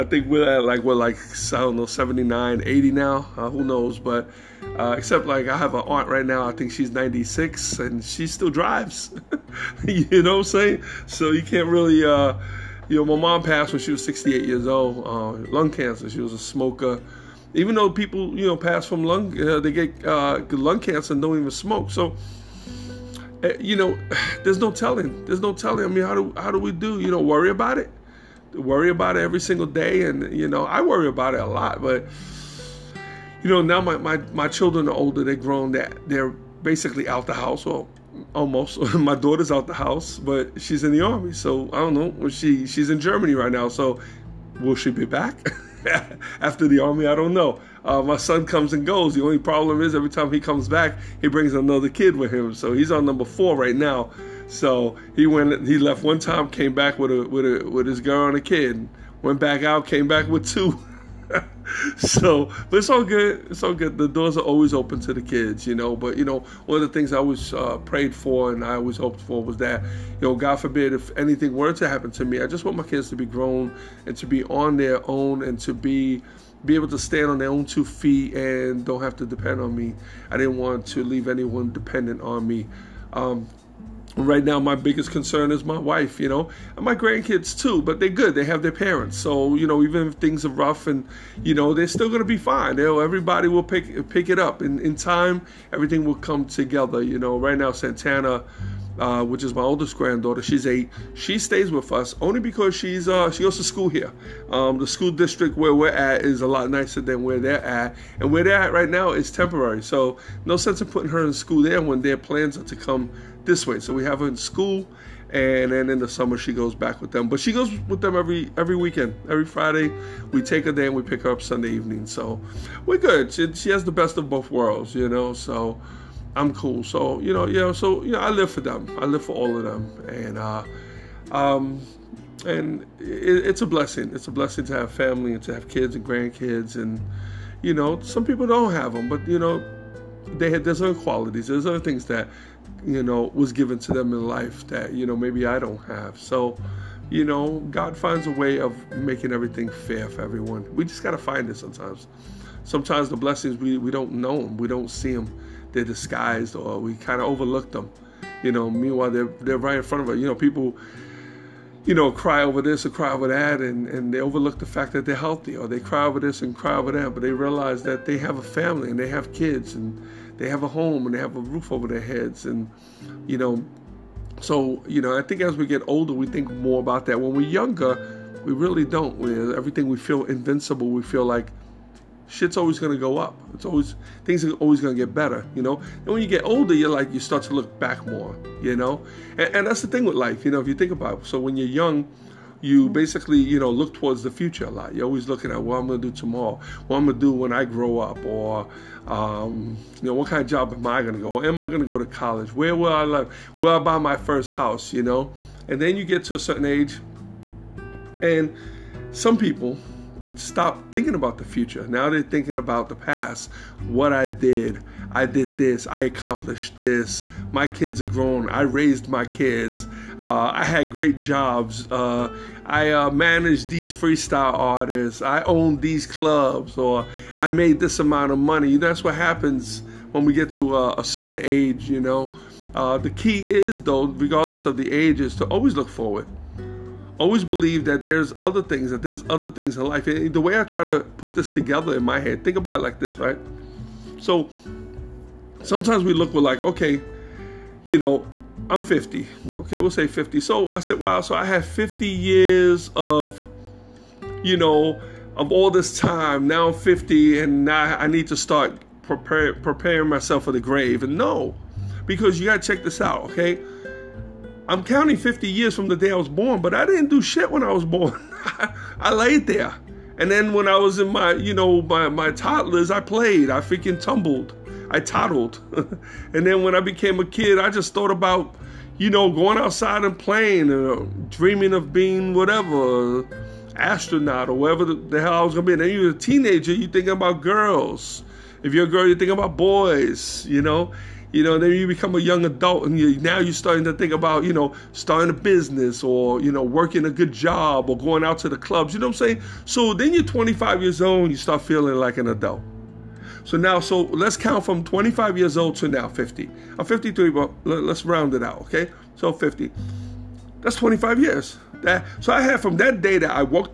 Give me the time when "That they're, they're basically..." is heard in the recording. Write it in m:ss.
0:35.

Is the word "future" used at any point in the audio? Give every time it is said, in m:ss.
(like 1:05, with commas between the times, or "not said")
3:14, 3:31.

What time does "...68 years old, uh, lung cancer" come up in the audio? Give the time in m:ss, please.
0:14.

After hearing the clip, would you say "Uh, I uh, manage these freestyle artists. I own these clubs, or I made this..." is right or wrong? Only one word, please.
right.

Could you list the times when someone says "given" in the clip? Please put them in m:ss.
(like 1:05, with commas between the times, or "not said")
2:23.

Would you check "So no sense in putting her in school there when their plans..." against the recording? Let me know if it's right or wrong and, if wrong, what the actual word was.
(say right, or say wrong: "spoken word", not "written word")
right.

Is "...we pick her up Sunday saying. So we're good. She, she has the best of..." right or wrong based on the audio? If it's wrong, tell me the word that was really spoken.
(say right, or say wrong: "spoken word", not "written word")
wrong: "evening", not "saying".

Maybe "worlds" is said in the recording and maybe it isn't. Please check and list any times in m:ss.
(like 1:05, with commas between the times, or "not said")
2:04.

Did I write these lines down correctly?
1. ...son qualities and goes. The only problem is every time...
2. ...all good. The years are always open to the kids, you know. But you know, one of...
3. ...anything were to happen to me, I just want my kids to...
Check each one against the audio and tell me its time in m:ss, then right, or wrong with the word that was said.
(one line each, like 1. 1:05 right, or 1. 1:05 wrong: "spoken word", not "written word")
1. 0:48 wrong: "comes", not "qualities"
2. 1:03 wrong: "doors", not "years"
3. 1:11 right.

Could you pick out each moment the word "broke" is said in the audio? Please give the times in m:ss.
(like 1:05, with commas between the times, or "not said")
not said.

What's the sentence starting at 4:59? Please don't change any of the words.
So then you're 25 years old, and you start feeling like an adult.